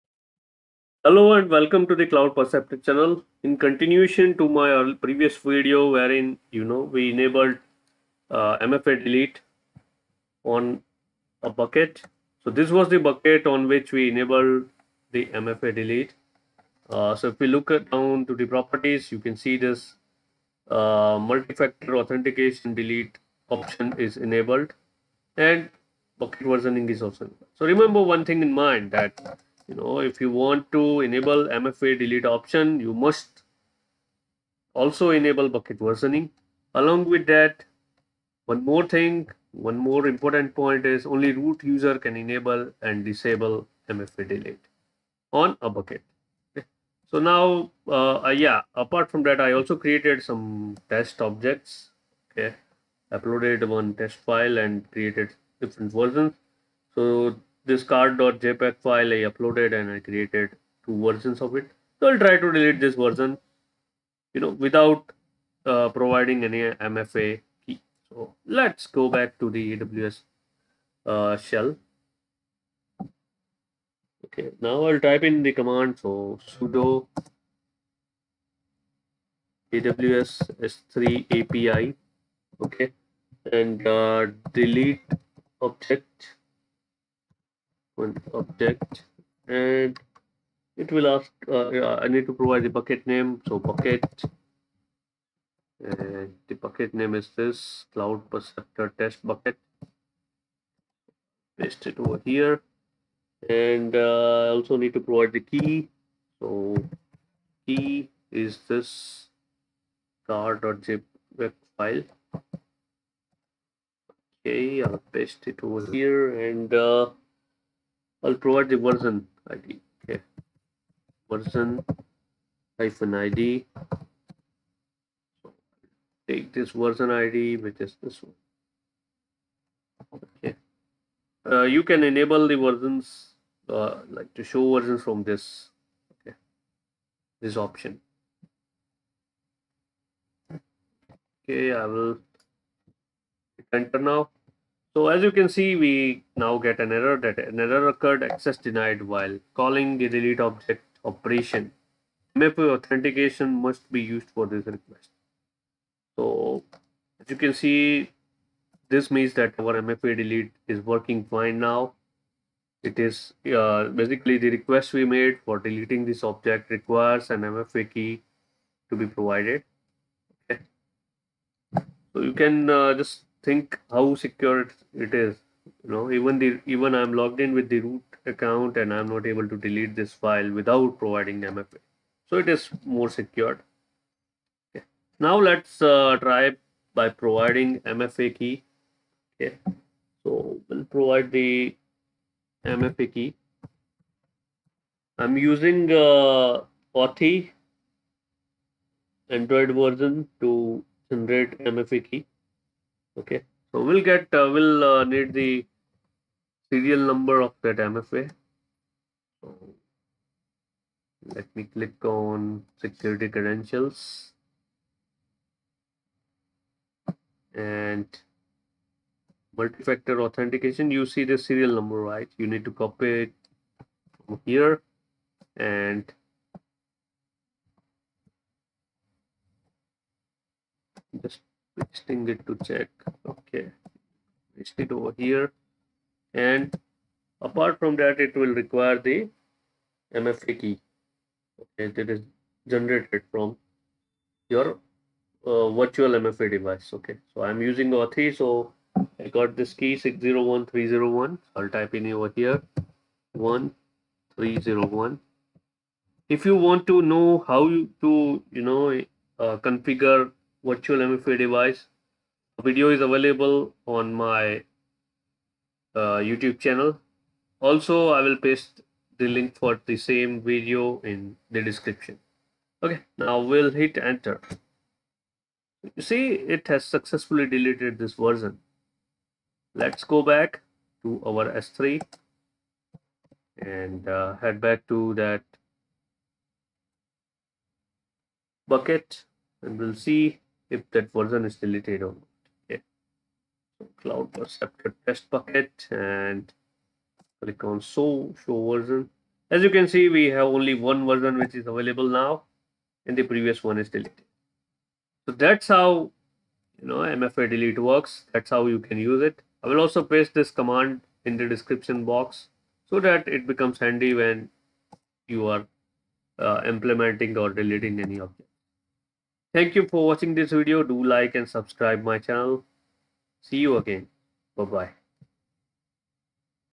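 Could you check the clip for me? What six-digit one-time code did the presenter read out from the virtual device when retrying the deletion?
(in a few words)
601301.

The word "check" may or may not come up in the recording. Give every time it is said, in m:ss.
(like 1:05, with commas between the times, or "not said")
3:52.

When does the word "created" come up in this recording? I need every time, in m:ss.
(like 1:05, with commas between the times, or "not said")
0:49, 0:54, 0:59.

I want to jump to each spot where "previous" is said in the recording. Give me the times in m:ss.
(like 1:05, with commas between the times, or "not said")
0:05, 5:03.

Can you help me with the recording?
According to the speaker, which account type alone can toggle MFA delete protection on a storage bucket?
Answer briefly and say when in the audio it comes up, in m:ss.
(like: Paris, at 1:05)
root user, at 0:41.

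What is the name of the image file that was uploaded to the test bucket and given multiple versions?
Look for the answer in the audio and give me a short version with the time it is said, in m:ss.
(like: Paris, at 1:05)
car.jpg, at 1:50.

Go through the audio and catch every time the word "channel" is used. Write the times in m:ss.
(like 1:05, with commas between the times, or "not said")
0:02, 4:26, 5:22.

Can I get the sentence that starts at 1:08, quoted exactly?
So let's go back to the AWS uh, shell.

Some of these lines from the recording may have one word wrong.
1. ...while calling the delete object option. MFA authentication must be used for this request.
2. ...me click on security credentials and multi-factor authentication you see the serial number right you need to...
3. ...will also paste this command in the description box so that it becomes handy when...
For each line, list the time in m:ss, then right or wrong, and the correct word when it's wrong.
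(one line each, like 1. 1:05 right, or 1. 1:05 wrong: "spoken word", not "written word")
1. 2:29 wrong: "operation", not "option"
2. 3:31 right
3. 5:09 right.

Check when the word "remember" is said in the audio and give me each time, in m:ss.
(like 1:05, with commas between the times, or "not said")
0:27.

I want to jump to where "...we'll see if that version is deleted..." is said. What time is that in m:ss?
4:49.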